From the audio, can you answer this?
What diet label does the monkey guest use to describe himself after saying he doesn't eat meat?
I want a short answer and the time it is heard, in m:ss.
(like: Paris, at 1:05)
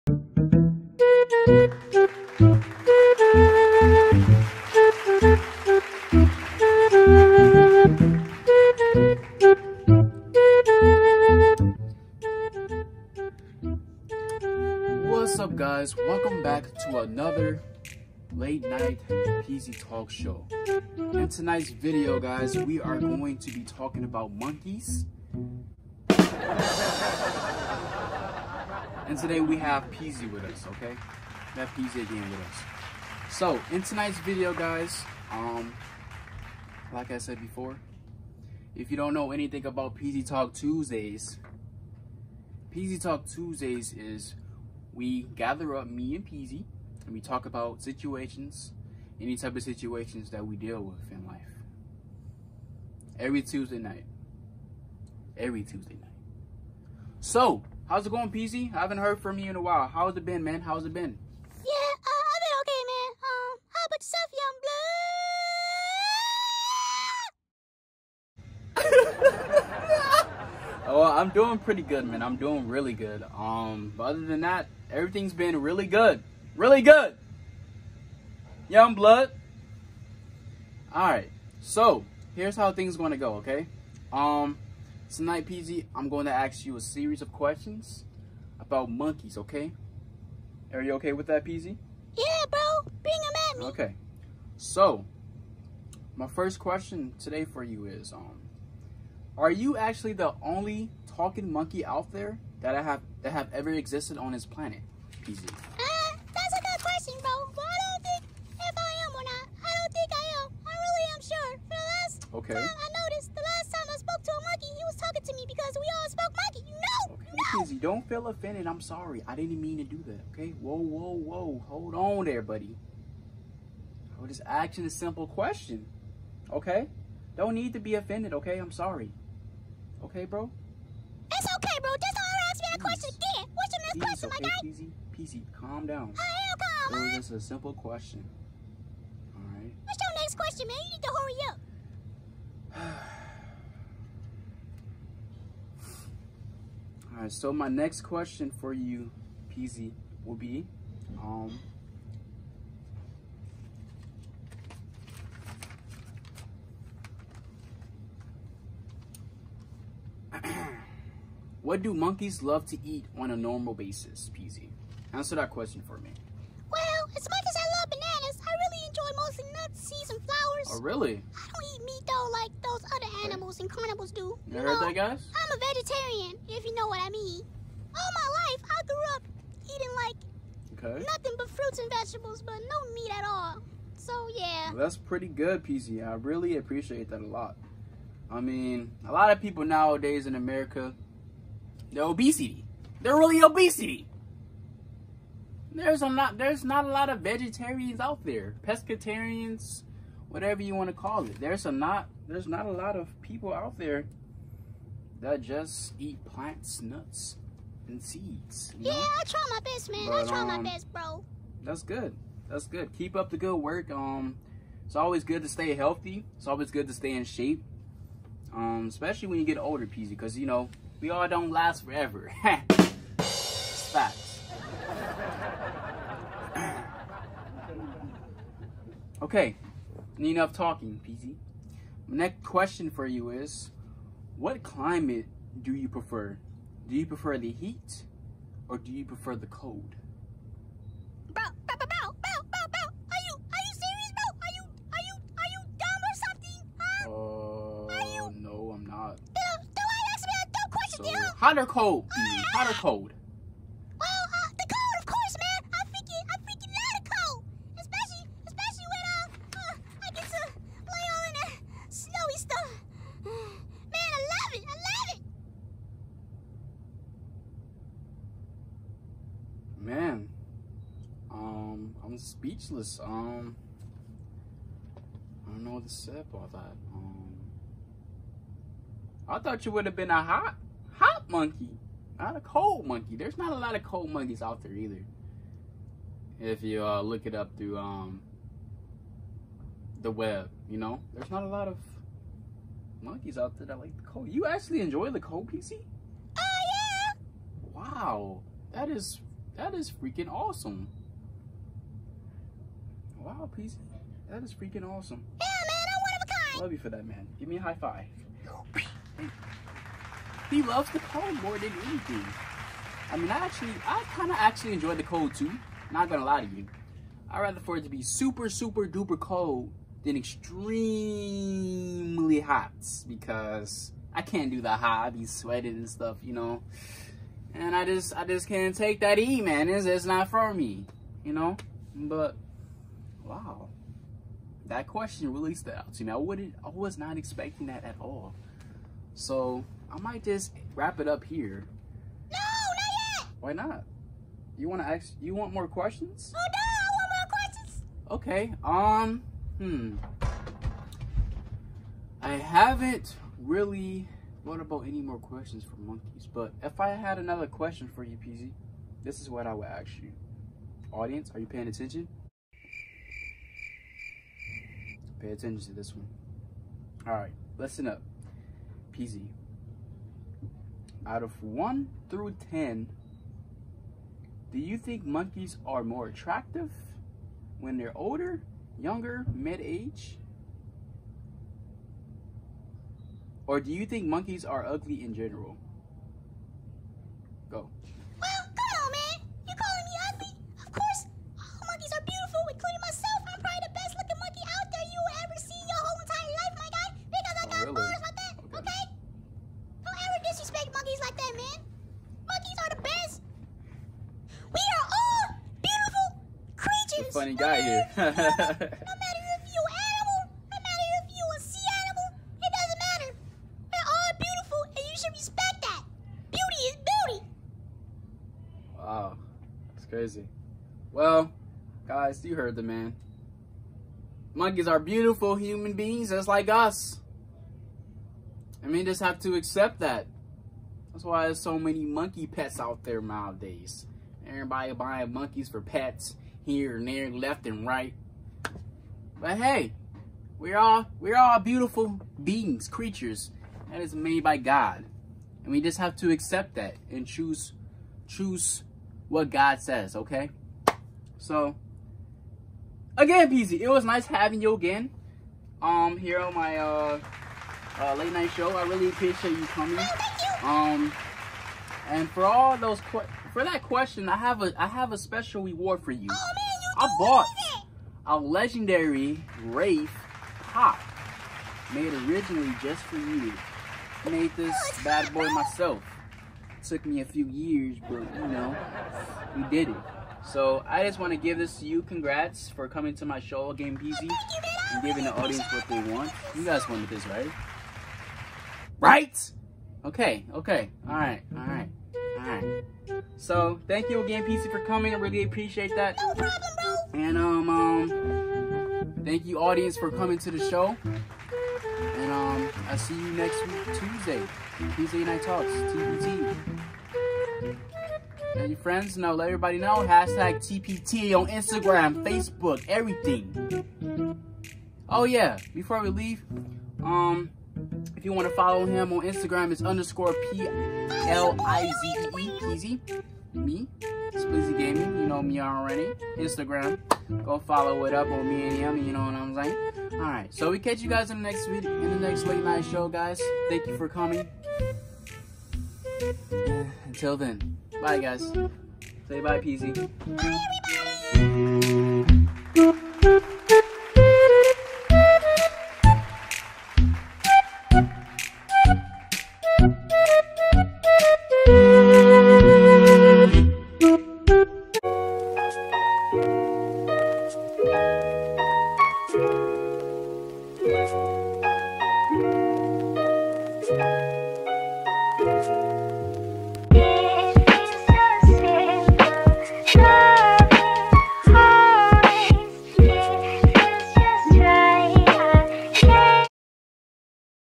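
Vegetarian, at 2:55.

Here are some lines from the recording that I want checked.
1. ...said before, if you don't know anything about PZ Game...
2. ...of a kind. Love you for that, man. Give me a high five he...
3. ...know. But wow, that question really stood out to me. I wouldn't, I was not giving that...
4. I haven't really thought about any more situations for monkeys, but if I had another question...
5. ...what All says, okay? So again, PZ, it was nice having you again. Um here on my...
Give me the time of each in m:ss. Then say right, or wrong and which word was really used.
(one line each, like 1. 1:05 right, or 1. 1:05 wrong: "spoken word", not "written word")
1. 0:37 wrong: "Talk", not "Game"
2. 5:06 right
3. 5:31 wrong: "expecting", not "giving"
4. 5:52 wrong: "questions", not "situations"
5. 7:29 wrong: "God", not "All".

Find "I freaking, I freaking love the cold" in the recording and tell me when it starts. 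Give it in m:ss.
4:15.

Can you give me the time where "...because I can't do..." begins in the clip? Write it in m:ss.
5:23.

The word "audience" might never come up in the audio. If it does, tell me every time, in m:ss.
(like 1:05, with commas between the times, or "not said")
6:00, 8:05, 8:19.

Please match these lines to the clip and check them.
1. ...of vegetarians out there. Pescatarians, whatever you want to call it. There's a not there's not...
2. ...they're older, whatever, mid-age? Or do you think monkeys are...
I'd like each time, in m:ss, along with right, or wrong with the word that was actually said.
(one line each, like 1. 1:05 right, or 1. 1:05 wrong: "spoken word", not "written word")
1. 3:17 right
2. 6:17 wrong: "younger", not "whatever".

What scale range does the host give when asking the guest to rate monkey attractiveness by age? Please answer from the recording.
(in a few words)
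1 through 10.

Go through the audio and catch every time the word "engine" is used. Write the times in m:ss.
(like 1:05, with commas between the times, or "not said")
not said.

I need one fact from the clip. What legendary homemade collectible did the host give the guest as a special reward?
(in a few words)
Wraith pop.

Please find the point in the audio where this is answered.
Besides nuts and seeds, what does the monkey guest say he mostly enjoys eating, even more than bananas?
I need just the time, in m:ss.
2:50.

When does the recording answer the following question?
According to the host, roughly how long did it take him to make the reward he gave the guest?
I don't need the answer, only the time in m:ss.
7:57.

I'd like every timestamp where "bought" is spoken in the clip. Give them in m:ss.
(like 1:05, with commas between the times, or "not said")
7:46.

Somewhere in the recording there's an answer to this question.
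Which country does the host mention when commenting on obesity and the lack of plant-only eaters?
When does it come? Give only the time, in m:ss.
3:10.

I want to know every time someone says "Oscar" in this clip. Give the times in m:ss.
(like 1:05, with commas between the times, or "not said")
not said.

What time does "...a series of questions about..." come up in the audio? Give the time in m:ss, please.
1:26.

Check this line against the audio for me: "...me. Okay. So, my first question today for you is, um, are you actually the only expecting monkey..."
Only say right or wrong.
wrong.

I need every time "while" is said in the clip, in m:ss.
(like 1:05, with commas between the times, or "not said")
0:59.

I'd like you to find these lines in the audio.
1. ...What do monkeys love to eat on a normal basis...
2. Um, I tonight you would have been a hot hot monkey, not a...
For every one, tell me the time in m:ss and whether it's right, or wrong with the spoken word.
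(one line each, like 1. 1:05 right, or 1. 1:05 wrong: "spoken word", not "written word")
1. 2:41 right
2. 4:36 wrong: "thought", not "tonight".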